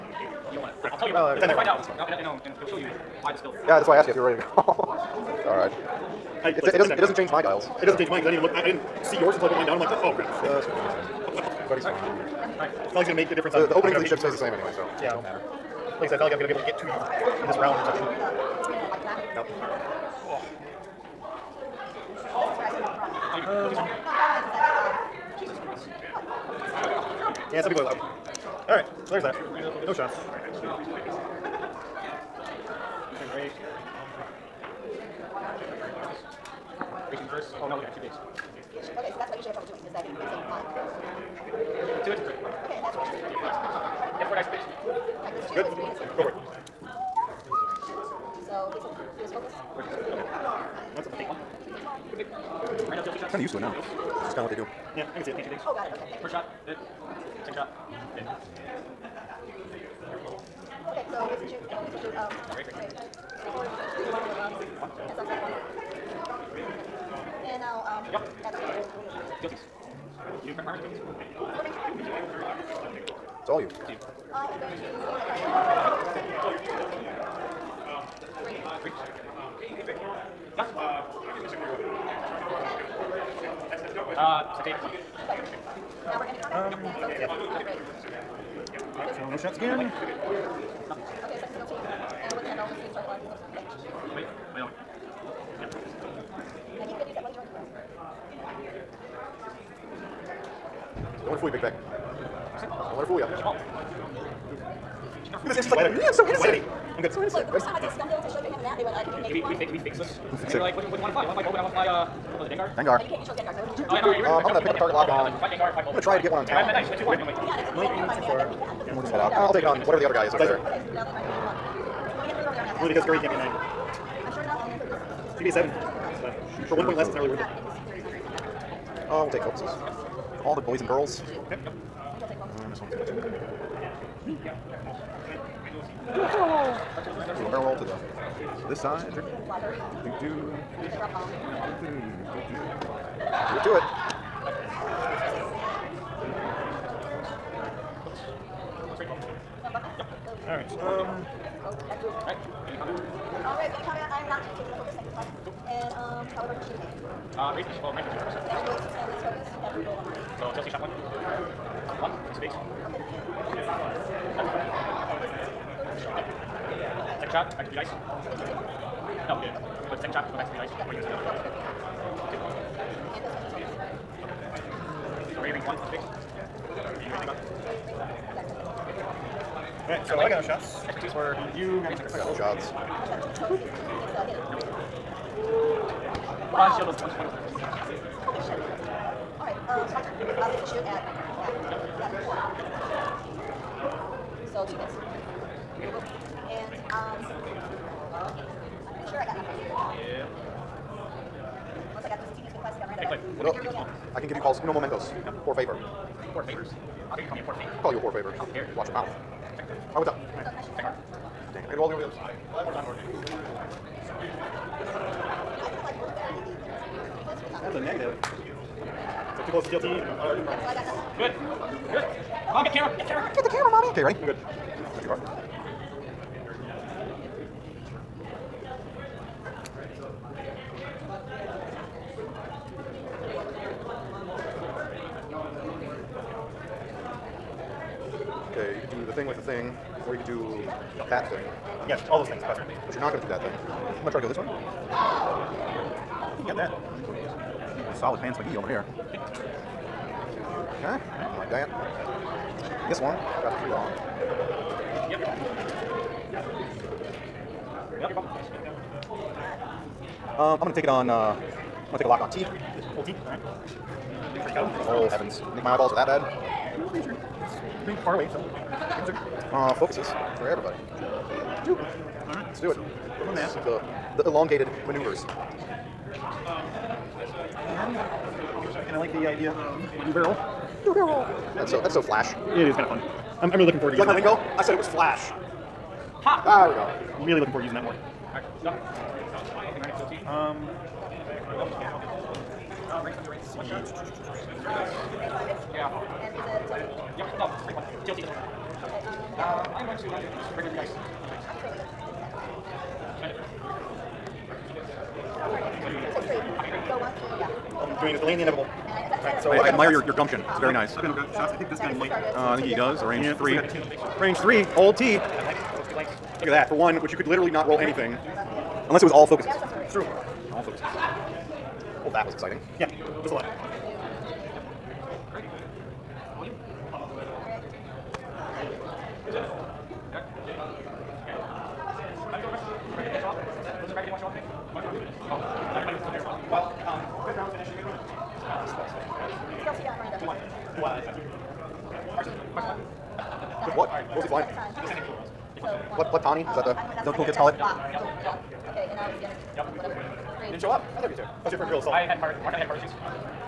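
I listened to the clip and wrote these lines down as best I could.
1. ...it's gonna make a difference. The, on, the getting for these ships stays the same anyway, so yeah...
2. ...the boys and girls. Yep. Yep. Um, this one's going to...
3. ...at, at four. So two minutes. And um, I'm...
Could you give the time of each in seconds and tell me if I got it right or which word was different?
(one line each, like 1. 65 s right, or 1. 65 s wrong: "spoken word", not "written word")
1. 13 s wrong: "opening", not "getting"
2. 130 s right
3. 191 s right.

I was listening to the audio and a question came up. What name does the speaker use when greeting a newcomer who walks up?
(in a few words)
Cliff.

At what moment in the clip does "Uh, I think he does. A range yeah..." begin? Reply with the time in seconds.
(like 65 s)
312 s.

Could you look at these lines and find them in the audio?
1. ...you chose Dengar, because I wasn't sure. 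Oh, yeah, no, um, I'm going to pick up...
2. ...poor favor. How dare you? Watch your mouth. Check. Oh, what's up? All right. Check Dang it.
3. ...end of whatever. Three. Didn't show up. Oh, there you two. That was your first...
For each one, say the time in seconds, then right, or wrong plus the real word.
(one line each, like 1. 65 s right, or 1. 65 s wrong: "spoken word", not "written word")
1. 113 s right
2. 207 s right
3. 349 s right.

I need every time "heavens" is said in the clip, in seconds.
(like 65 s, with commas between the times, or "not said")
265 s.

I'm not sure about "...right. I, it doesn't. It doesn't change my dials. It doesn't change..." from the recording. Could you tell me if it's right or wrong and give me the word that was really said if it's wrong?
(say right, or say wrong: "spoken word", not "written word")
right.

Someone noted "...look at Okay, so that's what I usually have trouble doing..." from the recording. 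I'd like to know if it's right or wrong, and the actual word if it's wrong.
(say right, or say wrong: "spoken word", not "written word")
right.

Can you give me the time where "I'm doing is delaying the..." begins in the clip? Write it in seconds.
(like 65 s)
307 s.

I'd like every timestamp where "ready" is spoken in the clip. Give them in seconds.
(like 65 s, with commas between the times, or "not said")
4 s, 224 s.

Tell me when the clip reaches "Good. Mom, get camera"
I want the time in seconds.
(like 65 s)
221 s.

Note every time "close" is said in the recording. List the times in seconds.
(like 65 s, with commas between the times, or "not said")
219 s.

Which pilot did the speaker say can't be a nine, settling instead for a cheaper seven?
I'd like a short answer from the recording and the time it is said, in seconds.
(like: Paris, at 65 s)
Curry, at 123 s.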